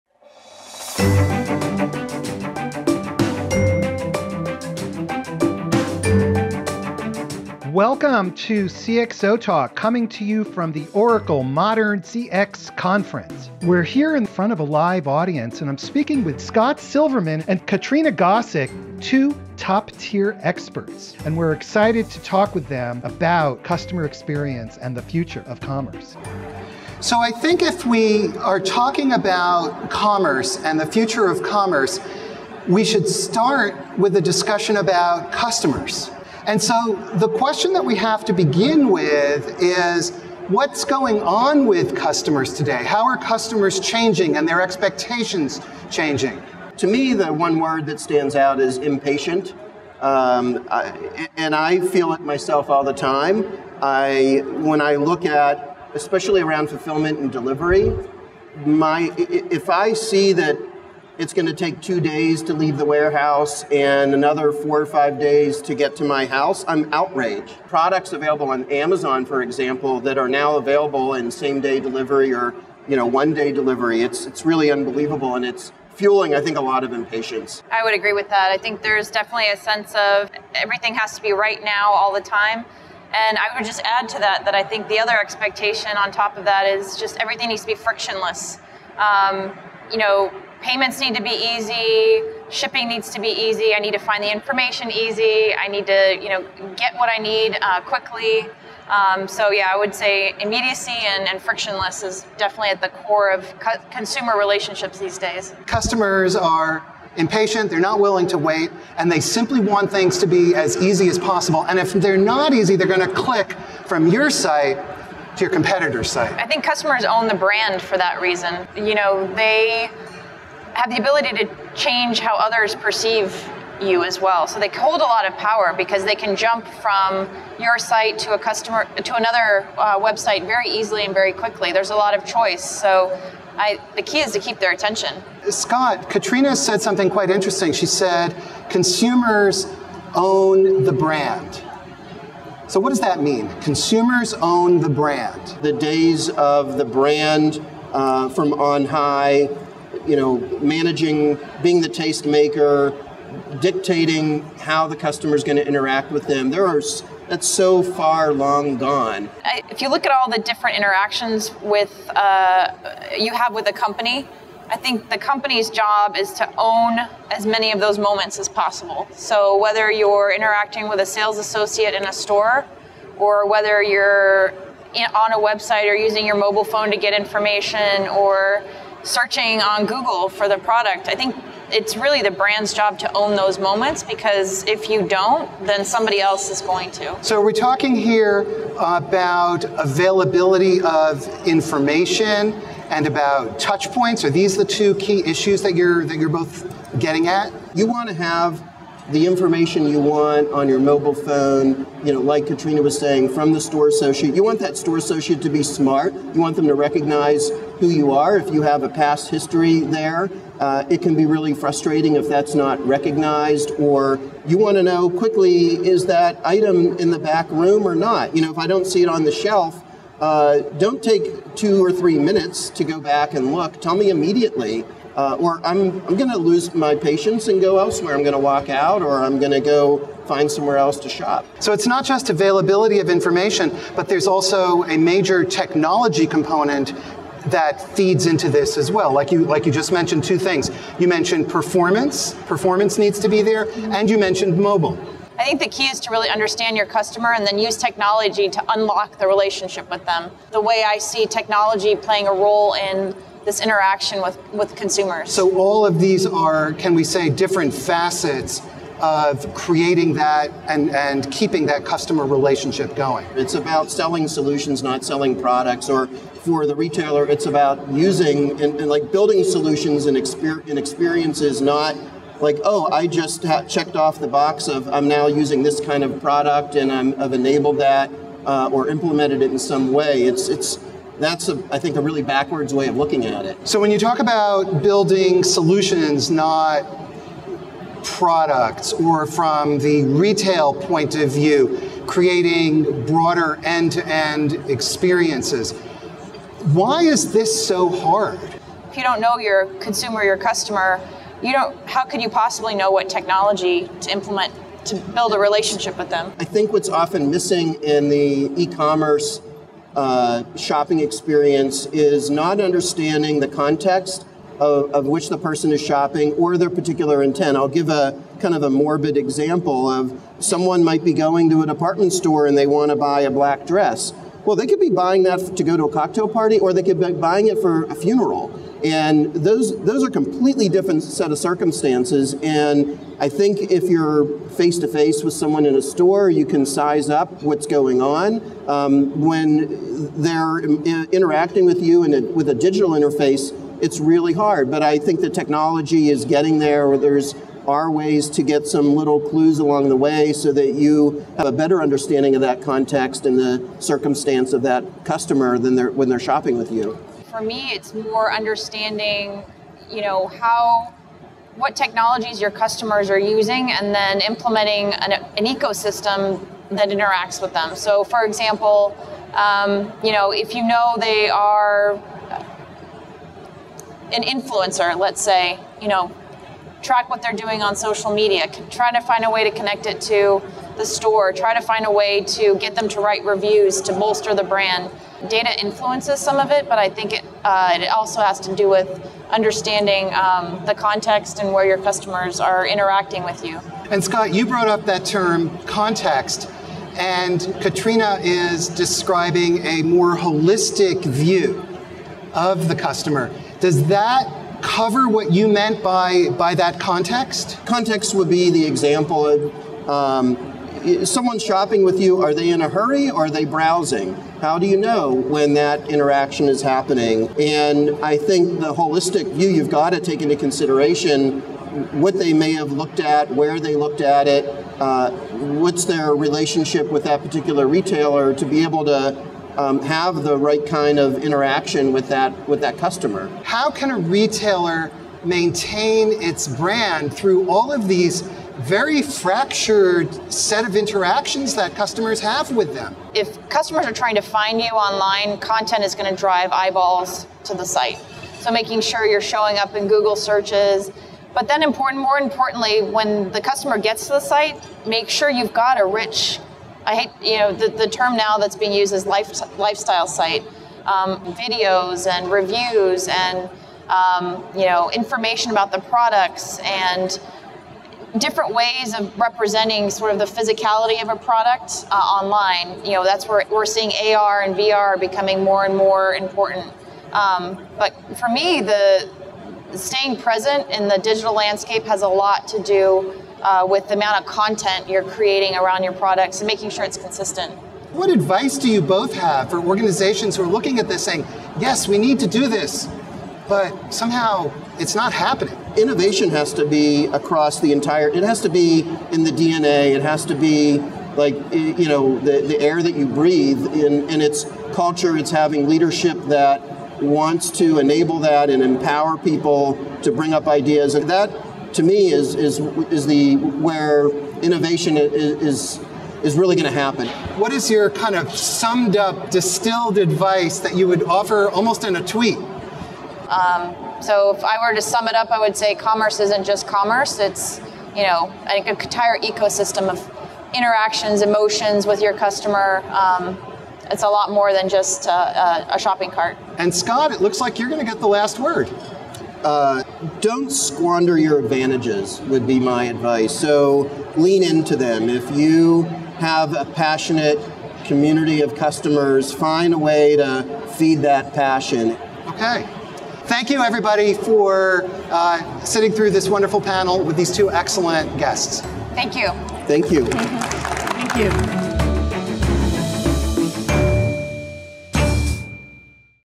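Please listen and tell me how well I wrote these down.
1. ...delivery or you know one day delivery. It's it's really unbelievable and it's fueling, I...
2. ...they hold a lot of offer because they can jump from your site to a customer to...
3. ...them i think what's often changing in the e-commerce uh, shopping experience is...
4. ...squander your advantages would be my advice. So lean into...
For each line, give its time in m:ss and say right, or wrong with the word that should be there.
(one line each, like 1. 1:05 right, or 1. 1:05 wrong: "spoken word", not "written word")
1. 1:11 right
2. 2:04 wrong: "power", not "offer"
3. 5:06 wrong: "missing", not "changing"
4. 9:00 right.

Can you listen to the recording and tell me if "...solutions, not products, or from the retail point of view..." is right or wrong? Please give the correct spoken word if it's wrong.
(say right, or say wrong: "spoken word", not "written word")
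right.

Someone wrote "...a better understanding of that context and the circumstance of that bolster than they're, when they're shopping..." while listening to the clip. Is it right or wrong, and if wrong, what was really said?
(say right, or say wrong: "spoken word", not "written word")
wrong: "customer", not "bolster".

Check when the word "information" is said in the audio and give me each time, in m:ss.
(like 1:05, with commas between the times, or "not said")
1:34, 2:57, 3:11, 3:19, 3:53, 7:44.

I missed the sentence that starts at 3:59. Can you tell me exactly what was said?
Like you, like you just mentioned two things.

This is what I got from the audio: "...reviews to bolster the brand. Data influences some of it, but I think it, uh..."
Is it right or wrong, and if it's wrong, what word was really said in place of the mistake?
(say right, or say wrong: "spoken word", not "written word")
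right.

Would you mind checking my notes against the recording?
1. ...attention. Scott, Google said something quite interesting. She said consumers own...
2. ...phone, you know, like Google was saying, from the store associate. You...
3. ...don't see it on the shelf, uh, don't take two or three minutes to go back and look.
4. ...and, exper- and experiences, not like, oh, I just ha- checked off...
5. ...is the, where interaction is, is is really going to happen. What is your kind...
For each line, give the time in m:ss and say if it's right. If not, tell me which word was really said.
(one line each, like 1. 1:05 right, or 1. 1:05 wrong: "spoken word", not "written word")
1. 2:14 wrong: "Katrina", not "Google"
2. 3:21 wrong: "Katrina", not "Google"
3. 3:38 right
4. 4:30 right
5. 8:32 wrong: "innovation", not "interaction".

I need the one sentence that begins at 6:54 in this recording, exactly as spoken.
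How do you know when that interaction is happening?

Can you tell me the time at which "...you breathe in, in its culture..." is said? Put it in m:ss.
8:22.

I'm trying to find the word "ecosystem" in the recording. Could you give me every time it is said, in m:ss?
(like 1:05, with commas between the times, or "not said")
6:05, 8:49.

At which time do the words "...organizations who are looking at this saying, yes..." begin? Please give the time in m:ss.
8:09.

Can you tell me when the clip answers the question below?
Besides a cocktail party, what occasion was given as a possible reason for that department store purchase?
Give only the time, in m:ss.
5:27.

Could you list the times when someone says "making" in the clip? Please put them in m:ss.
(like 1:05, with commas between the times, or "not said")
7:28, 8:06.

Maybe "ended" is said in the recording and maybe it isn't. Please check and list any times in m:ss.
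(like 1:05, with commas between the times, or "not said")
not said.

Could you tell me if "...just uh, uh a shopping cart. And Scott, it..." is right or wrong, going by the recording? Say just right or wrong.
right.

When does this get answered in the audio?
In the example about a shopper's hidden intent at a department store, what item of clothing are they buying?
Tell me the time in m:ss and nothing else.
5:23.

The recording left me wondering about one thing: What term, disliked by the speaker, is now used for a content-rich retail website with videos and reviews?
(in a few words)
Lifestyle site.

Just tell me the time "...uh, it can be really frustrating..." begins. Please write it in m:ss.
3:30.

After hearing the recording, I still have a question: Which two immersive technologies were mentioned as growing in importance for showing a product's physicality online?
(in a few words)
AR and VR.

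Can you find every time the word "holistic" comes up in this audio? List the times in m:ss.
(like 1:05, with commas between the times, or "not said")
6:40, 6:58.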